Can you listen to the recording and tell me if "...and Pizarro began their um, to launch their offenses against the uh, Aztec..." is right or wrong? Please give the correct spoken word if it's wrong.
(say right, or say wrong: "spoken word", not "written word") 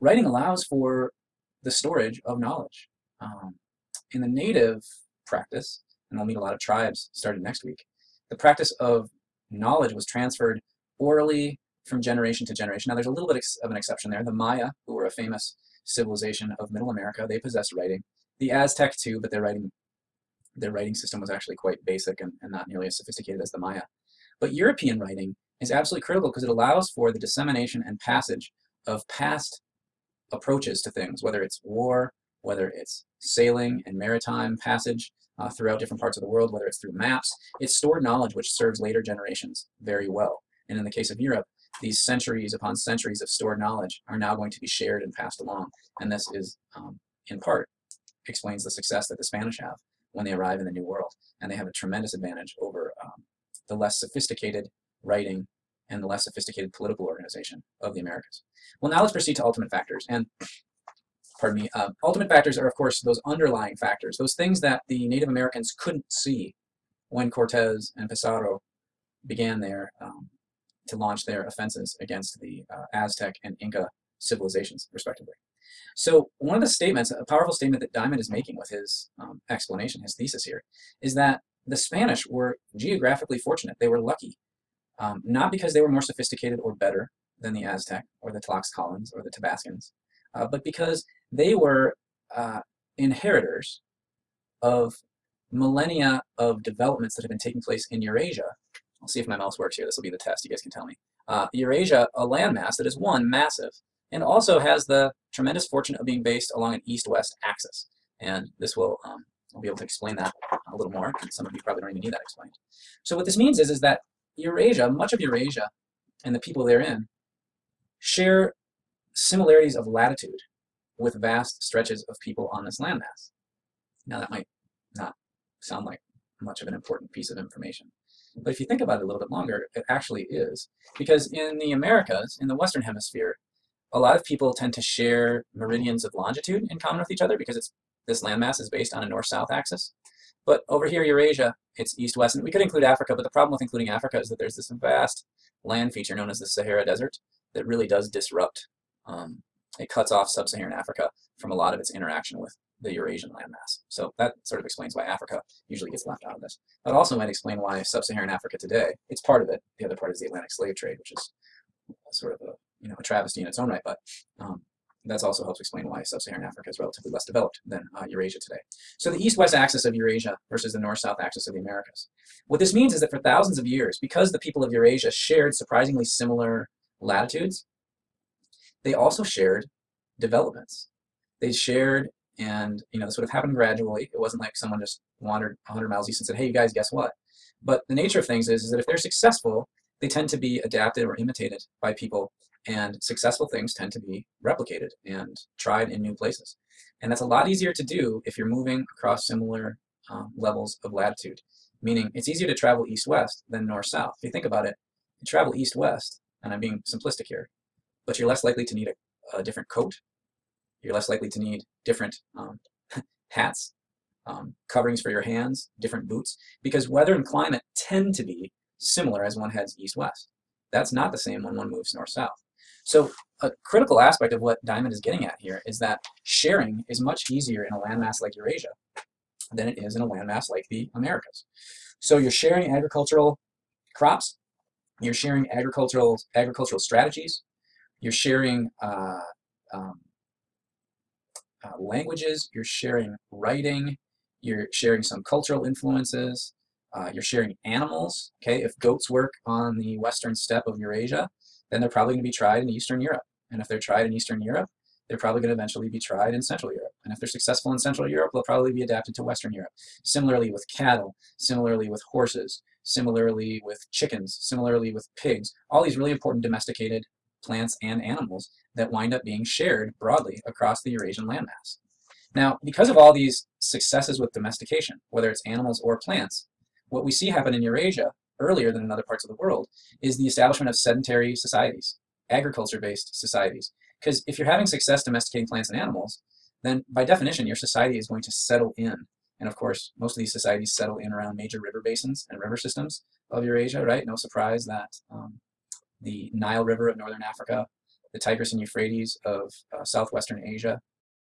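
right.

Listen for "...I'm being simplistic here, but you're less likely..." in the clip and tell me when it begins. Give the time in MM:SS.
03:26.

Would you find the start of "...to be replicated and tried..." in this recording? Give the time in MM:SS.
03:13.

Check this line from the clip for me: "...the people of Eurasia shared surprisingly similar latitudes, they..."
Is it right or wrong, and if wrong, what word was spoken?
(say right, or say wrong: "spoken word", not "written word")
right.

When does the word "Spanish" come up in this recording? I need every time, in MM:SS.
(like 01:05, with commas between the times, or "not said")
00:49, 01:21.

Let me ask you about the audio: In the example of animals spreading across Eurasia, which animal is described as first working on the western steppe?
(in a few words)
goats.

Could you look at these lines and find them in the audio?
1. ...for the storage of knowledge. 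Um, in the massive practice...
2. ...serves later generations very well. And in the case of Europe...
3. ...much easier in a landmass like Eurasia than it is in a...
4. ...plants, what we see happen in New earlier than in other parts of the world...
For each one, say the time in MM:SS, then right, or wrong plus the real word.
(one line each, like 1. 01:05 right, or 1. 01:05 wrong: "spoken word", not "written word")
1. 00:00 wrong: "native", not "massive"
2. 00:38 right
3. 03:46 right
4. 04:35 wrong: "Eurasia", not "New".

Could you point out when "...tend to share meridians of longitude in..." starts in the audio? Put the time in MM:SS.
02:14.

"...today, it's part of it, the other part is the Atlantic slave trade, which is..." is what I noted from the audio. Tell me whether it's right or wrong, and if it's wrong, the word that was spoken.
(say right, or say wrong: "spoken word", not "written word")
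right.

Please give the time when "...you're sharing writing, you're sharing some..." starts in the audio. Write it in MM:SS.
04:02.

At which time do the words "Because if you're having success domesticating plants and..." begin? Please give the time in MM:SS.
04:44.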